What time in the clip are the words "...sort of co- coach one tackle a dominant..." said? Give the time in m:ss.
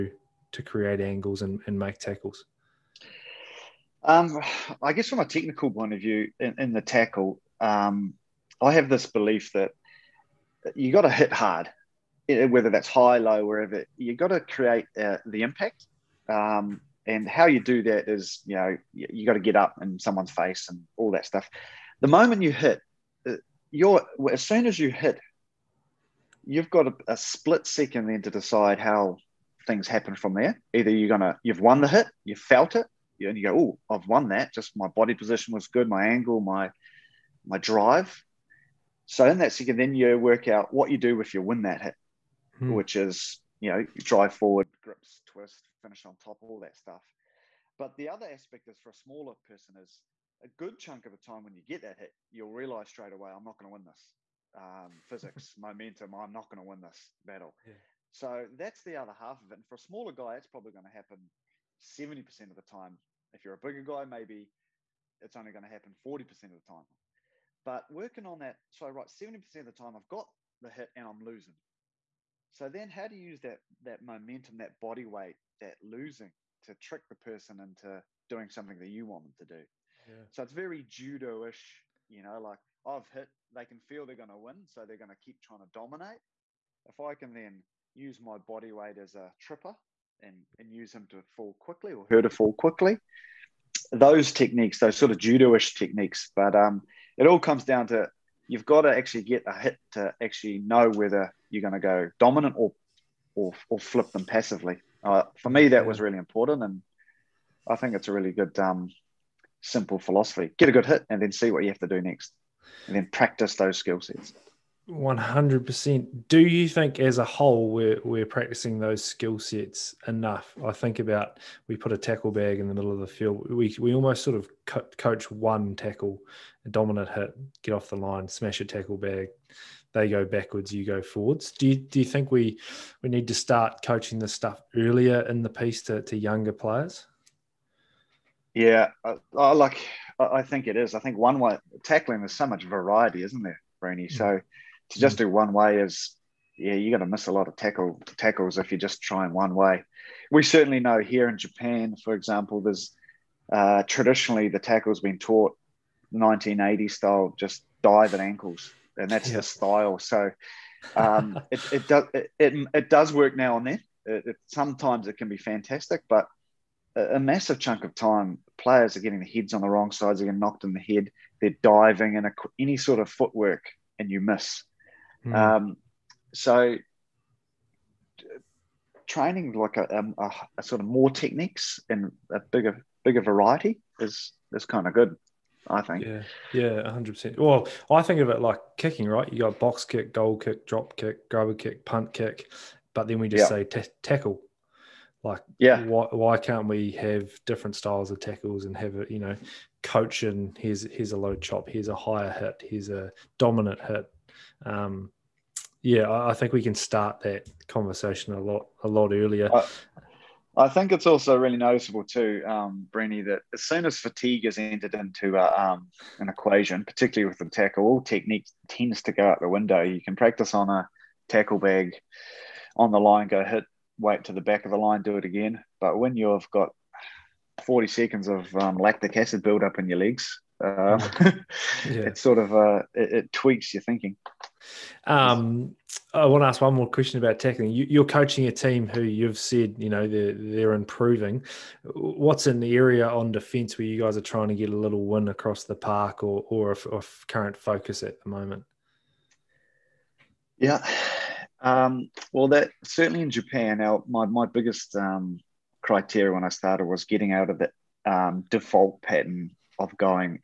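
2:04.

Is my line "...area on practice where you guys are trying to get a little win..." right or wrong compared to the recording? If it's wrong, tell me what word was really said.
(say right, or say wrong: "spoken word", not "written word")
wrong: "defence", not "practice".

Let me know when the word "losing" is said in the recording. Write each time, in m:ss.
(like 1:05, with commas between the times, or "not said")
1:11, 1:15.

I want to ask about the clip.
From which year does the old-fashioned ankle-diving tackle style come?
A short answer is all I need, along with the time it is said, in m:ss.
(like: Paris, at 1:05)
1980, at 2:36.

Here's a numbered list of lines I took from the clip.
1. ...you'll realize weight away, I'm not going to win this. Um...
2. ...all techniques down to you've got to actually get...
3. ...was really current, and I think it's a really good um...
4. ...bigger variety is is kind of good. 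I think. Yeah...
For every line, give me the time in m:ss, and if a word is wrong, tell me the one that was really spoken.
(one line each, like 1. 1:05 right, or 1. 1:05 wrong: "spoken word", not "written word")
1. 0:52 wrong: "straight", not "weight"
2. 1:37 wrong: "comes", not "techniques"
3. 1:45 wrong: "important", not "current"
4. 3:03 right.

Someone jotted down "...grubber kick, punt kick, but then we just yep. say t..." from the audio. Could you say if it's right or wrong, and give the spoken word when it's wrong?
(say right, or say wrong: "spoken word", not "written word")
right.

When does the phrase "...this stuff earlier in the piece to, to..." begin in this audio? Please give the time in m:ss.
2:14.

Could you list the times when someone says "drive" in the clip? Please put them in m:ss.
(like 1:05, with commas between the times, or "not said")
0:37, 0:44.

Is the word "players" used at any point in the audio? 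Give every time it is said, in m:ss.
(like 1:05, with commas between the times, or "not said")
2:16, 2:48.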